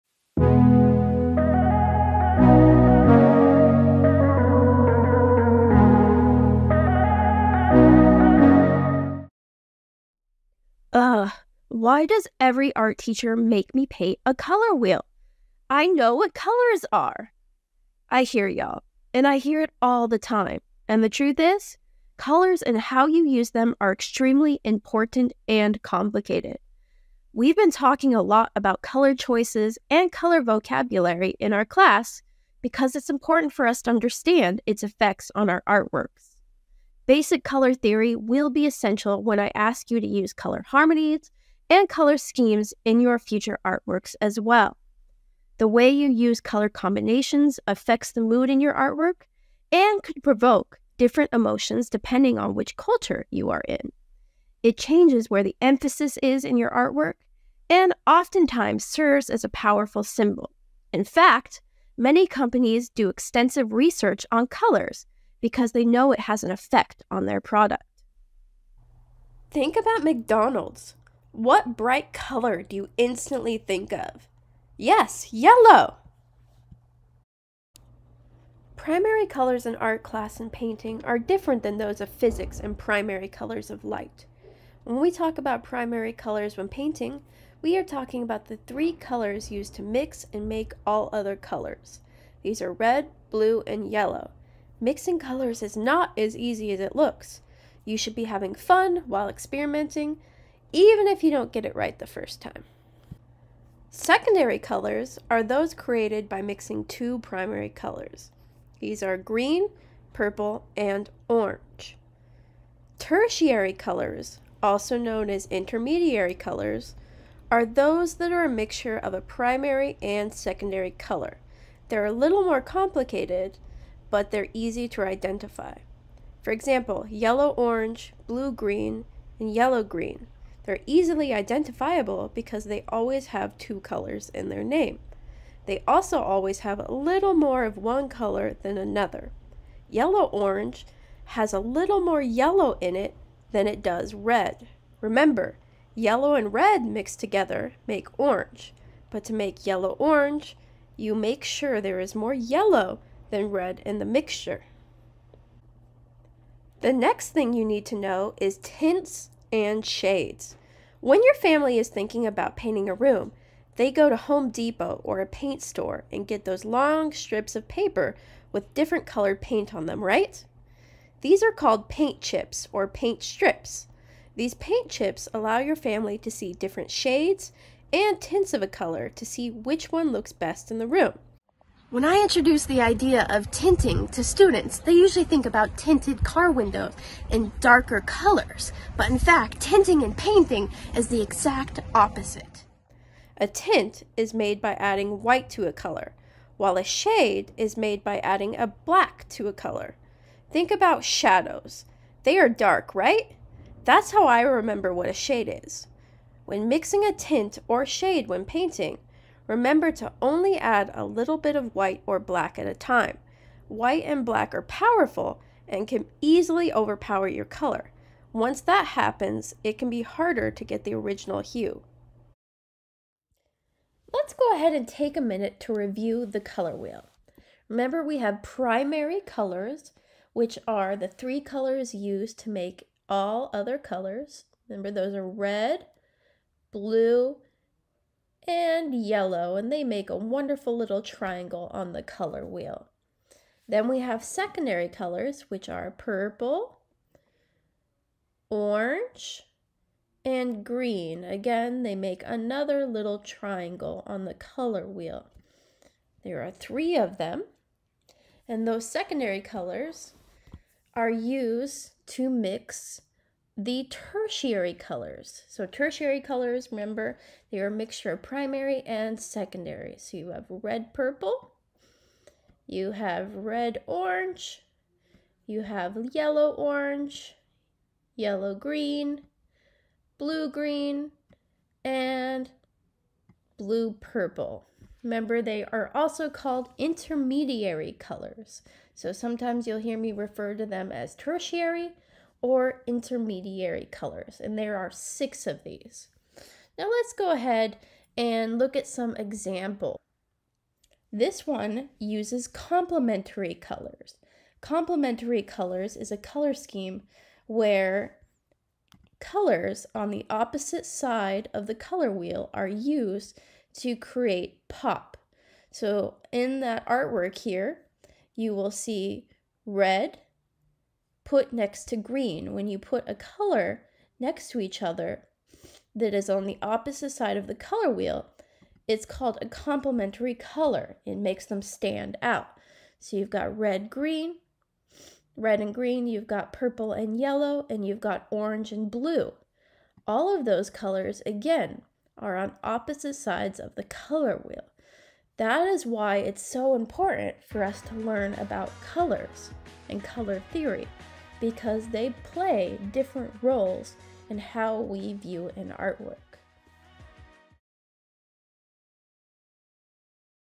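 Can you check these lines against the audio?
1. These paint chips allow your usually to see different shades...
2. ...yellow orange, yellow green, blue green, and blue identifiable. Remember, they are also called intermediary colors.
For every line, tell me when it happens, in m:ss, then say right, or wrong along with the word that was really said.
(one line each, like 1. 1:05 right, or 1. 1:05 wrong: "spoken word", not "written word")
1. 2:54 wrong: "family", not "usually"
2. 4:36 wrong: "purple", not "identifiable".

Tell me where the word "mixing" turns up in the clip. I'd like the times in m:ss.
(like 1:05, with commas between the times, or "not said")
1:34, 1:46, 3:26.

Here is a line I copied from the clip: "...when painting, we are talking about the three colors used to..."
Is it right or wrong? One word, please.
right.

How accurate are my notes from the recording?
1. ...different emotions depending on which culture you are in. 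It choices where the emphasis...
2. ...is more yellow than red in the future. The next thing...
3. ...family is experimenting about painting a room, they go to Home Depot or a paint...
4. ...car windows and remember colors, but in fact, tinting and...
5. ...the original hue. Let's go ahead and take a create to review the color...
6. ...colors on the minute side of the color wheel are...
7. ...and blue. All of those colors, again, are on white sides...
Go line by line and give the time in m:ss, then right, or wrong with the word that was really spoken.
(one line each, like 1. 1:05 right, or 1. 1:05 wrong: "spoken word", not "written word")
1. 0:50 wrong: "changes", not "choices"
2. 2:31 wrong: "mixture", not "future"
3. 2:41 wrong: "thinking", not "experimenting"
4. 3:06 wrong: "darker", not "remember"
5. 3:40 wrong: "minute", not "create"
6. 5:09 wrong: "opposite", not "minute"
7. 5:38 wrong: "opposite", not "white".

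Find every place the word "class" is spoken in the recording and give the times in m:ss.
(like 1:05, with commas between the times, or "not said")
0:31, 1:20.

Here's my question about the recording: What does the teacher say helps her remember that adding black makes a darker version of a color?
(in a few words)
shadows.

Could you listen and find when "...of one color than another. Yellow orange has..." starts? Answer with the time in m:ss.
2:17.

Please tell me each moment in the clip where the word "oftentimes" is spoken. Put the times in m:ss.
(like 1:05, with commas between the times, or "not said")
0:58.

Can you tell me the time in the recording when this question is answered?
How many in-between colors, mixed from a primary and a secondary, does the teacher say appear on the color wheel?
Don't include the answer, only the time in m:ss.
4:54.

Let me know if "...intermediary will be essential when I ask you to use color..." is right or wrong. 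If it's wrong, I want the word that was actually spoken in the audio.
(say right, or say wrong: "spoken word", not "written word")
wrong: "theory", not "intermediary".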